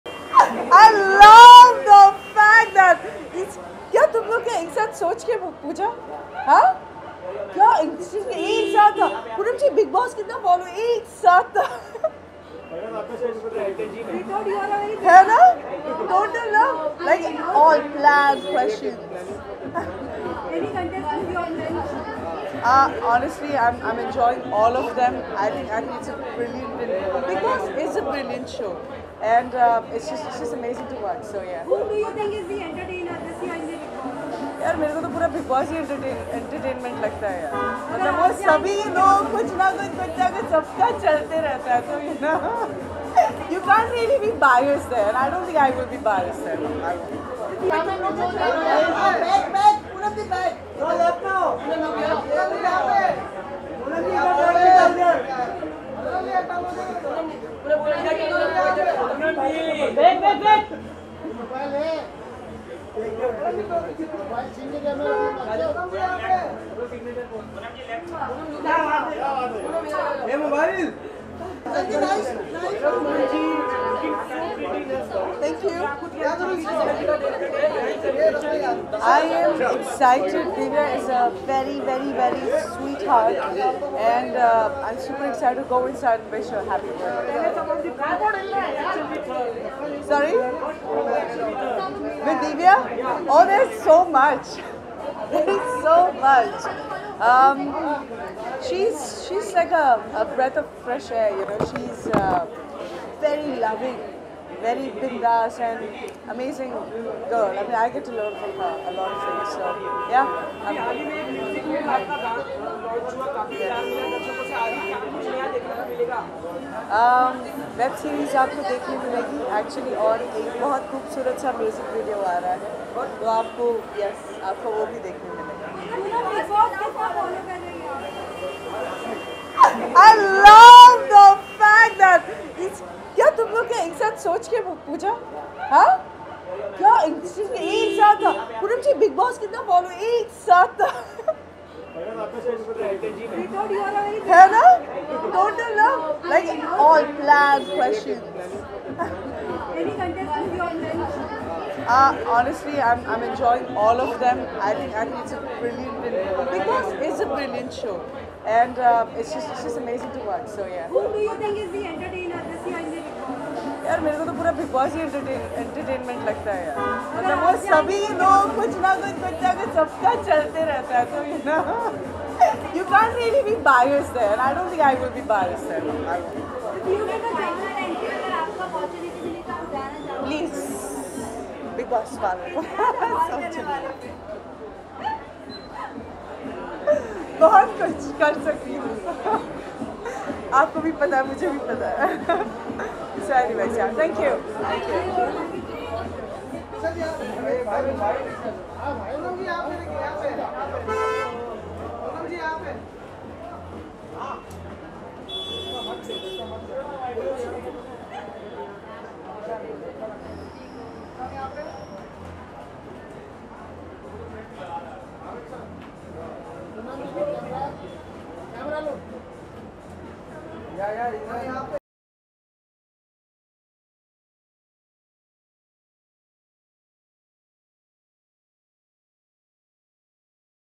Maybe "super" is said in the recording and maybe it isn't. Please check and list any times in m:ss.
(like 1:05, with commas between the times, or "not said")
1:24.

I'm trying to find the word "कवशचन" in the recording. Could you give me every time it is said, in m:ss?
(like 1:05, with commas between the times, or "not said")
0:18, 2:27.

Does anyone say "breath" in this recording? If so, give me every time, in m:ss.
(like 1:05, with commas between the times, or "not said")
1:40.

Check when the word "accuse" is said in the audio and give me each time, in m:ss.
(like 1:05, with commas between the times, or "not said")
not said.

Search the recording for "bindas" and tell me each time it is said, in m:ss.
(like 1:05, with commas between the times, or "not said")
1:44.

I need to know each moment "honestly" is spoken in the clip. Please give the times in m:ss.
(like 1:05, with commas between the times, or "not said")
0:23, 2:32.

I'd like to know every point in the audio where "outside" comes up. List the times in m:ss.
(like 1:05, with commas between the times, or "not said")
not said.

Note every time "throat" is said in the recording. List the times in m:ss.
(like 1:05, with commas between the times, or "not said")
not said.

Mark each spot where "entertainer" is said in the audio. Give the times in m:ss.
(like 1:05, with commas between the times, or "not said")
0:32, 2:41.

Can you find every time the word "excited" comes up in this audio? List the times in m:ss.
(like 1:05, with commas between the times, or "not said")
1:19, 1:25.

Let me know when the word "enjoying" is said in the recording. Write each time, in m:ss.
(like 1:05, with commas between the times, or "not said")
0:23, 2:33.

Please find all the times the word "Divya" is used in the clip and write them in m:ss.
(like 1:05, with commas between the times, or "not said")
1:20, 1:32.